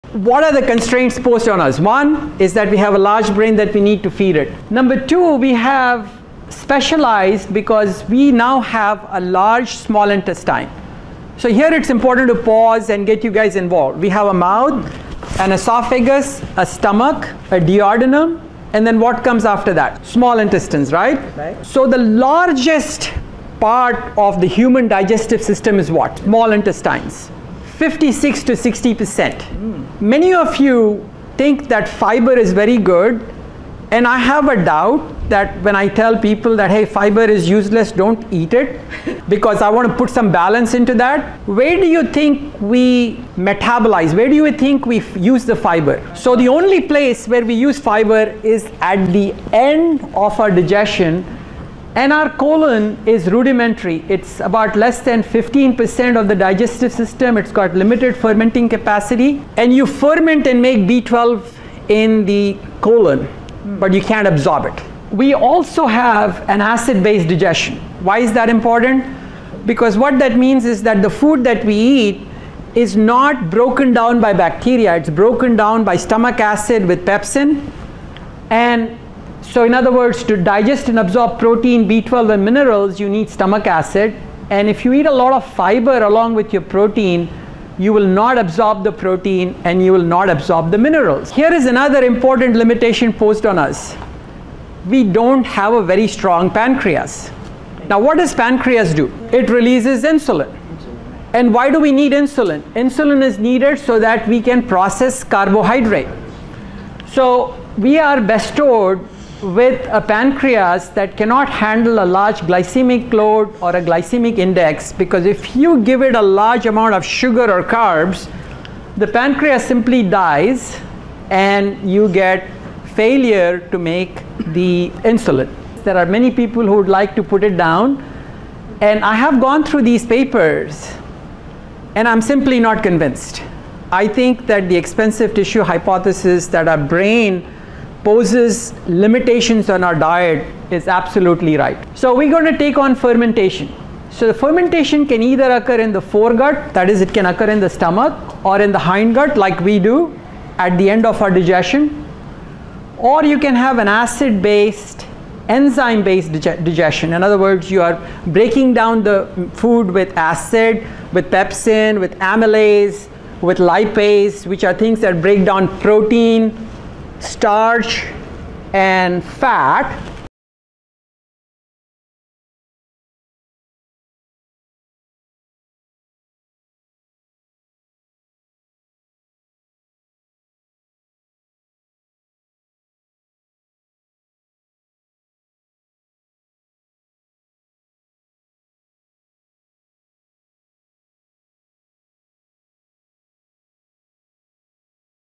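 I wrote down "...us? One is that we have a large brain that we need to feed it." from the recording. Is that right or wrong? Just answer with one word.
right.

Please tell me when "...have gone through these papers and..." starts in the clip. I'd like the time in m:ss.
2:09.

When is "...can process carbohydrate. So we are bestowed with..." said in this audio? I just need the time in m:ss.
1:44.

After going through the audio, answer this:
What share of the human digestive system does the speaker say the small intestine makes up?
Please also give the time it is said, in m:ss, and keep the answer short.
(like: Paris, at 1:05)
56 to 60 percent, at 0:27.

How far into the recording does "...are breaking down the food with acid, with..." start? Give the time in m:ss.
2:37.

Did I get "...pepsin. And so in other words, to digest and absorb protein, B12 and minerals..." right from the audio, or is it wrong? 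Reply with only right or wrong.
right.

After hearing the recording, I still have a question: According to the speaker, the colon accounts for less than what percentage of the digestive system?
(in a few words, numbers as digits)
15%.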